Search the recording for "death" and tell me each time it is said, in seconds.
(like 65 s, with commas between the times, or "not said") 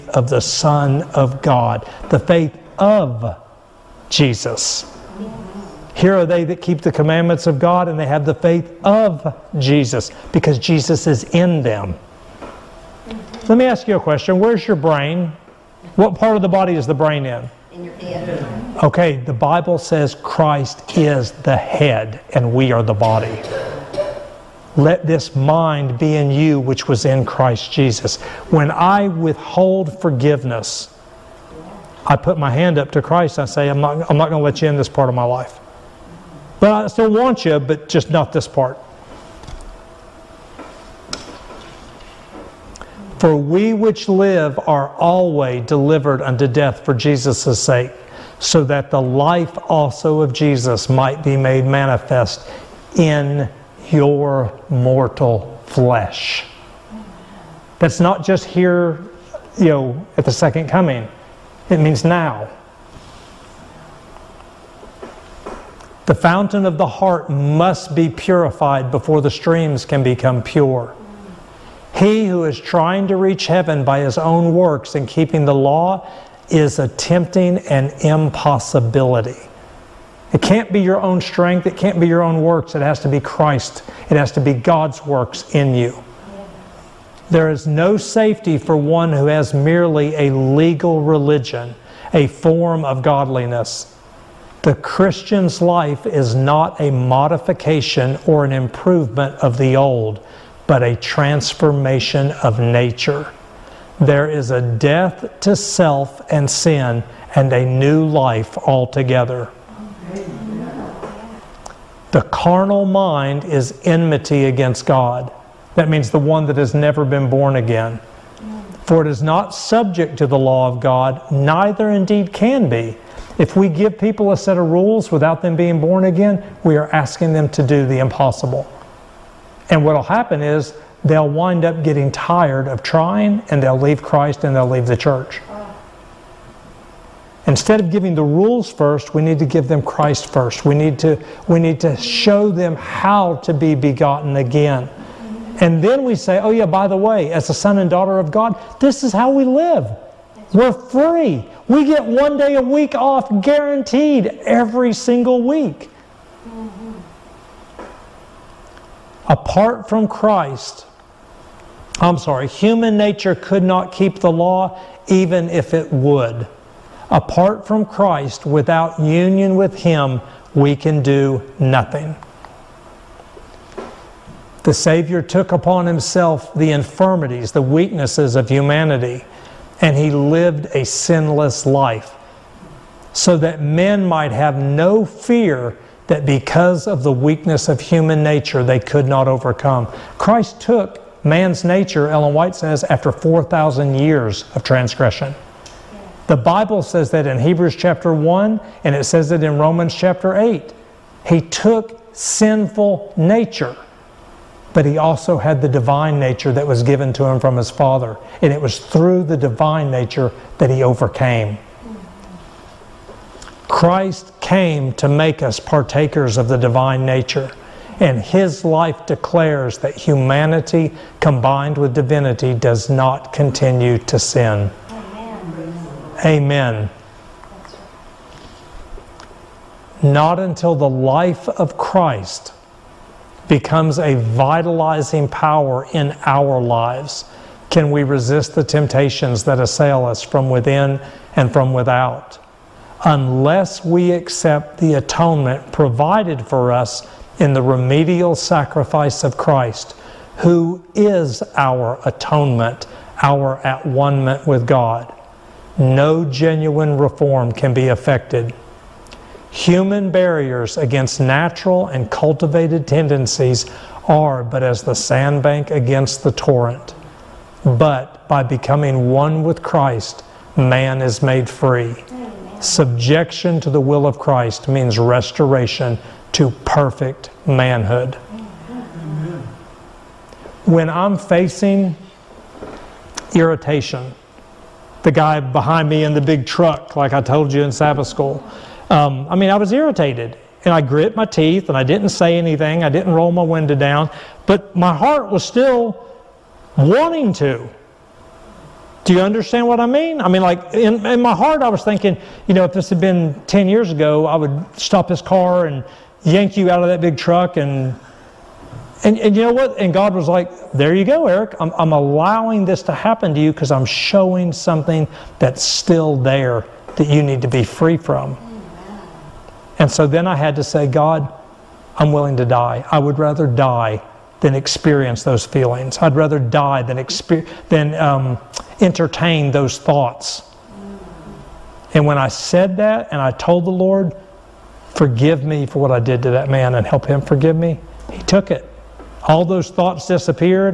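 46 s, 104 s.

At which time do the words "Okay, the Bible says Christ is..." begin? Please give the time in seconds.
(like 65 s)
18 s.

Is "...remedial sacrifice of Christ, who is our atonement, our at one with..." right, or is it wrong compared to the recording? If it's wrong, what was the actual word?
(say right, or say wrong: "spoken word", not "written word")
right.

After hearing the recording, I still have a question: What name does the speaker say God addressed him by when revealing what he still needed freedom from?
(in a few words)
Eric.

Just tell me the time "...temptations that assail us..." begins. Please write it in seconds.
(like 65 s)
238 s.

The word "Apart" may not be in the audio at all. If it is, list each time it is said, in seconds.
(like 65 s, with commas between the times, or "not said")
159 s, 167 s.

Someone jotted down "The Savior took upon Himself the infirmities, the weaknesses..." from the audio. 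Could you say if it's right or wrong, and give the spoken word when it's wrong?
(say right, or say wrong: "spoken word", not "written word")
right.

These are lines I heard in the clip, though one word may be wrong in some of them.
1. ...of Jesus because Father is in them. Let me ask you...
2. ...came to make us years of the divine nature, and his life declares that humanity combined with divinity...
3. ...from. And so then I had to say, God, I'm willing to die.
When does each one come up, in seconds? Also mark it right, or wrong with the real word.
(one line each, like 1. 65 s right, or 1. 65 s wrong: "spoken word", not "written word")
1. 8 s wrong: "Jesus", not "Father"
2. 214 s wrong: "partakers", not "years"
3. 317 s right.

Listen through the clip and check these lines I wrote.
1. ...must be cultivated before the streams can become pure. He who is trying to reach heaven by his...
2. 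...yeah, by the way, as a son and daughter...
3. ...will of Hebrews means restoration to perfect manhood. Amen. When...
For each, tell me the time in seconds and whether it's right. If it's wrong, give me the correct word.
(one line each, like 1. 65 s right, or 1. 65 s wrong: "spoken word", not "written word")
1. 67 s wrong: "purified", not "cultivated"
2. 146 s right
3. 273 s wrong: "Christ", not "Hebrews".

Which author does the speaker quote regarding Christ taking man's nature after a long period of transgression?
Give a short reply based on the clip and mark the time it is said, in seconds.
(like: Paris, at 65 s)
Ellen White, at 192 s.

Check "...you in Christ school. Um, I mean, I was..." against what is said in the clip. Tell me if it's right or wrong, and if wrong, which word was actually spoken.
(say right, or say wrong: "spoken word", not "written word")
wrong: "Sabbath", not "Christ".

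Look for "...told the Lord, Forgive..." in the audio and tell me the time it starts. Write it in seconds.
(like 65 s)
333 s.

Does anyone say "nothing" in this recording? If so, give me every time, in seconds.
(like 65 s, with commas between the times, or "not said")
171 s.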